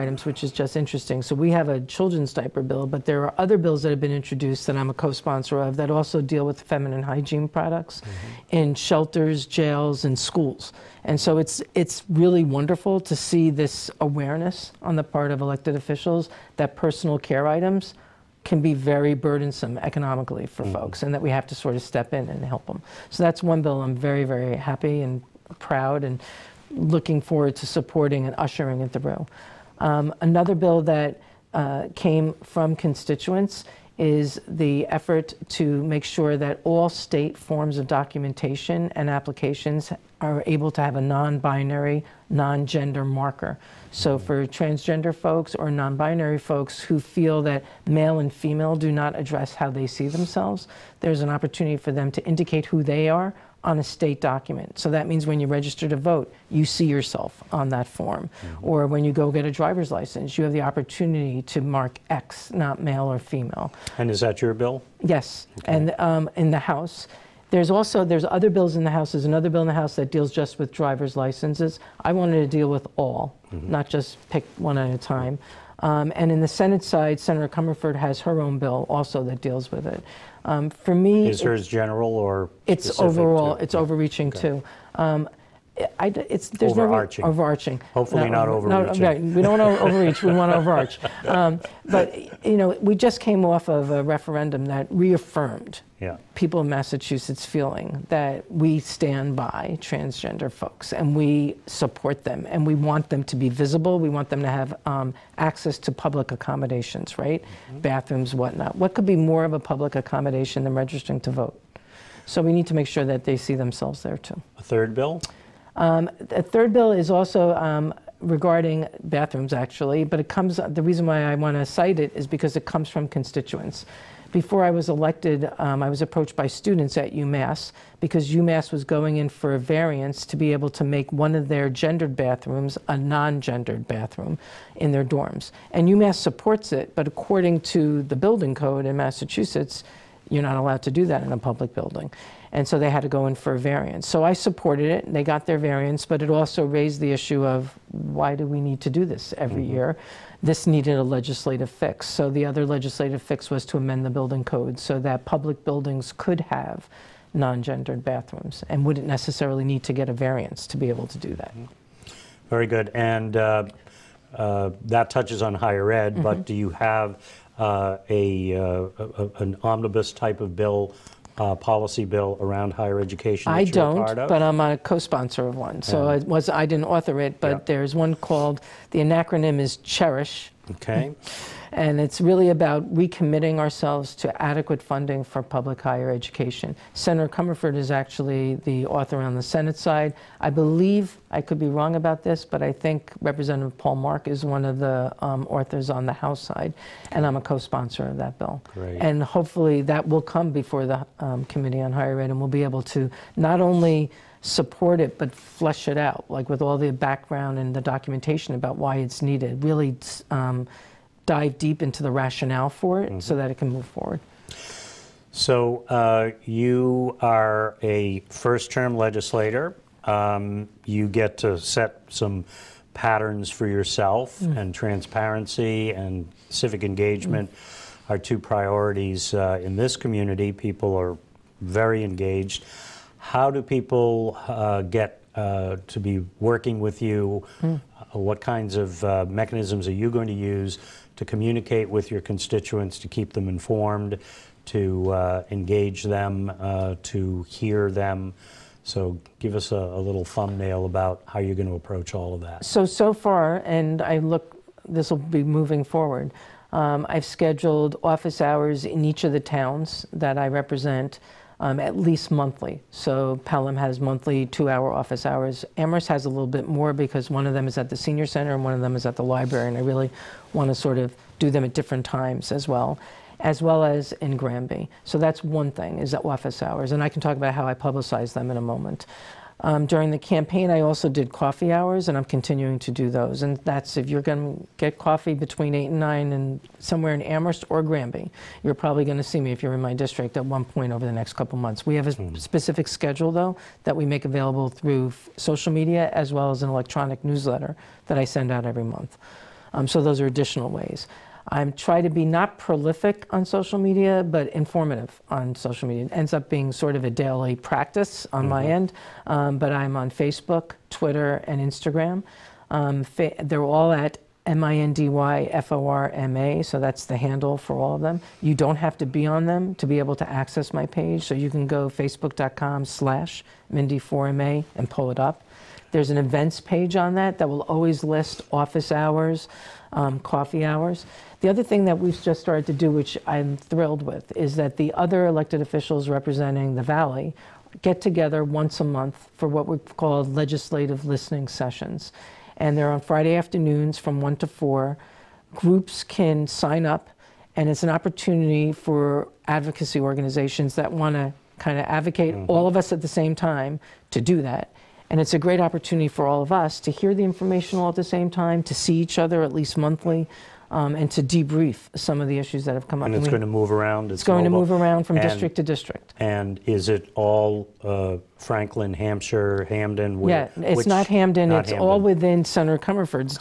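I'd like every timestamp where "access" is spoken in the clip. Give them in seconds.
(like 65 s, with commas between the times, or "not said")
105 s, 320 s.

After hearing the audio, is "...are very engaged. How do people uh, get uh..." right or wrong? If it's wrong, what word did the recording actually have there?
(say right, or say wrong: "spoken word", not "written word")
right.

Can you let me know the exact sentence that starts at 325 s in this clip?
There's an events page on that that will always list office hours, um, coffee hours.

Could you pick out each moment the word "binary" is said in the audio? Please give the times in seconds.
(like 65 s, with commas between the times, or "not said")
41 s, 45 s.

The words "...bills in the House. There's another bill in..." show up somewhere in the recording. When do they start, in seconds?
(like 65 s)
68 s.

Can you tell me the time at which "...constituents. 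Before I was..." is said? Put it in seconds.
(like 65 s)
123 s.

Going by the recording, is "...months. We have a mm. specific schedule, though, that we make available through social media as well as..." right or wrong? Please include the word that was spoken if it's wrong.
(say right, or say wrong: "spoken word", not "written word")
right.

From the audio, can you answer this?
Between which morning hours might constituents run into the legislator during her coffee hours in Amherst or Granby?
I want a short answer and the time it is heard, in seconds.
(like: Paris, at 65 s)
8 and 9, at 285 s.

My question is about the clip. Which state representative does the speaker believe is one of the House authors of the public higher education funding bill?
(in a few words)
Paul Mark.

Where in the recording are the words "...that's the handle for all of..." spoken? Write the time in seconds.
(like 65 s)
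316 s.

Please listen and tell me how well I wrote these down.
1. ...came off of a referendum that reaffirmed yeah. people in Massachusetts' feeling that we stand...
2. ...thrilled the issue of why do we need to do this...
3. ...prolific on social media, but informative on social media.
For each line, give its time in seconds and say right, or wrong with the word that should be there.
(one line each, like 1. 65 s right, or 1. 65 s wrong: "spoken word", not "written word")
1. 93 s right
2. 146 s wrong: "raised", not "thrilled"
3. 302 s right.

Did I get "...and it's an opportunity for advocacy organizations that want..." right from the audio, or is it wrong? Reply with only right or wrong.
right.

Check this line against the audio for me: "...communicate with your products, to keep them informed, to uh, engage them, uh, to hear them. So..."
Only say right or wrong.
wrong.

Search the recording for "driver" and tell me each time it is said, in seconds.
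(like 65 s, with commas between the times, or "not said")
59 s, 70 s.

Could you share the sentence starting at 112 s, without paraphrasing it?
So we need to make sure that they see themselves there too.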